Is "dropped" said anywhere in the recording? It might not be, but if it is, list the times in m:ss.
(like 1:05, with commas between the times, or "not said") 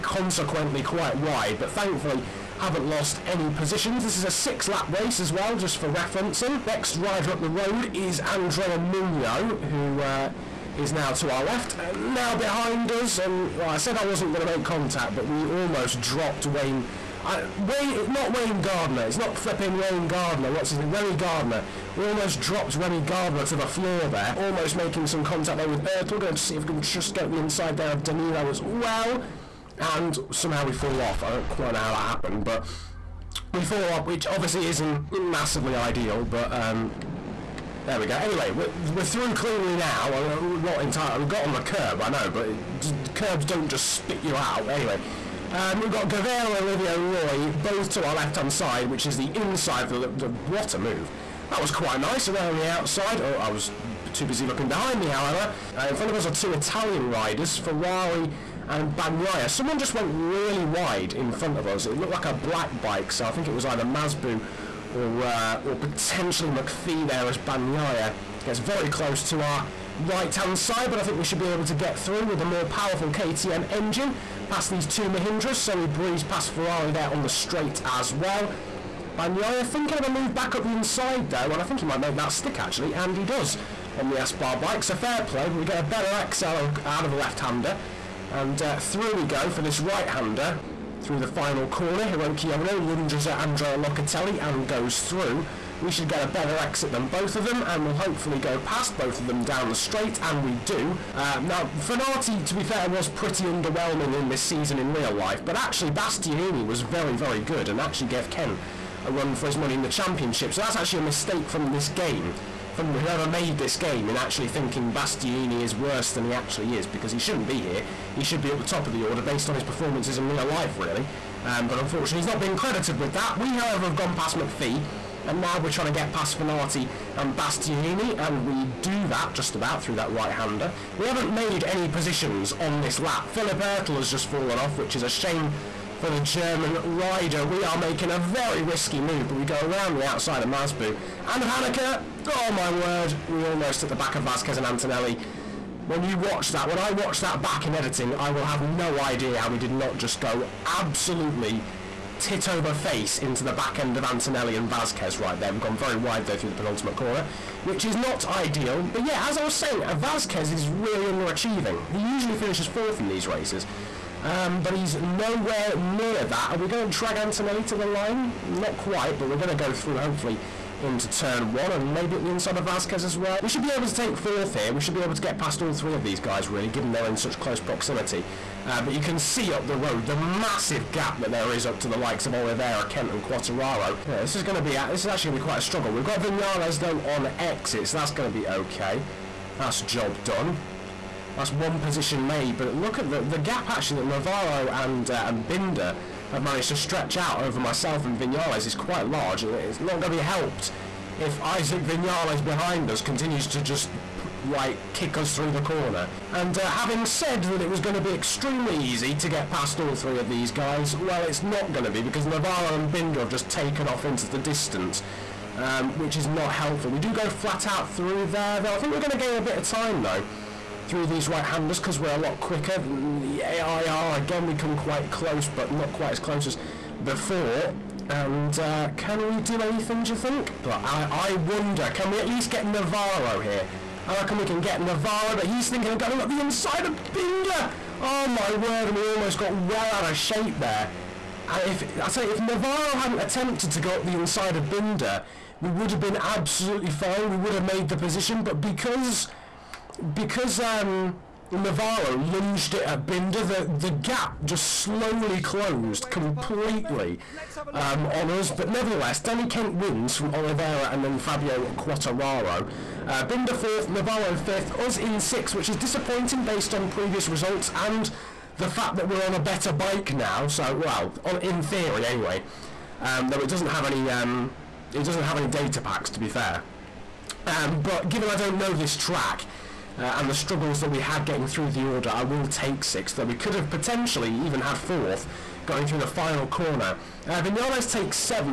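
0:16, 0:22.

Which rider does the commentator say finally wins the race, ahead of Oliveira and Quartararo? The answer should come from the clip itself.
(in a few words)
Danny Kent.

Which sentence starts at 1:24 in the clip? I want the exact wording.
So fair play, but we get a better XL out of the left-hander.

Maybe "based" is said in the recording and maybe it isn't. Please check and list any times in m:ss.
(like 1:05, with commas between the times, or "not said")
1:59, 4:26.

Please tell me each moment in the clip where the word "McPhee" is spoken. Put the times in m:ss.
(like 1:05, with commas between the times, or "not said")
1:06, 2:04.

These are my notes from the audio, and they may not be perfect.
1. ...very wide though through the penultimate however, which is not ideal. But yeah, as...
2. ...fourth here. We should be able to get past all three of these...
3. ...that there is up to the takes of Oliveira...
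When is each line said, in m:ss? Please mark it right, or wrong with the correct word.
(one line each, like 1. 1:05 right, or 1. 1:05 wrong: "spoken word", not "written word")
1. 2:35 wrong: "corner", not "however"
2. 2:54 right
3. 3:01 wrong: "likes", not "takes".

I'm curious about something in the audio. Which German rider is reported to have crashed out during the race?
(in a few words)
Philipp Öttl.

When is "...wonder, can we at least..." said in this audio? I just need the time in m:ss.
3:51.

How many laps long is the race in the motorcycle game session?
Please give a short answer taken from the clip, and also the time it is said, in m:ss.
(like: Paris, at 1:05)
6, at 0:04.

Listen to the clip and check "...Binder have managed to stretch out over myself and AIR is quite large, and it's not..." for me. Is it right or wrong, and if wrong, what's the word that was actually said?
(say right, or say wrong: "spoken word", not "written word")
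wrong: "Vinales", not "AIR".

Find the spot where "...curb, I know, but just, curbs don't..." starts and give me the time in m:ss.
0:41.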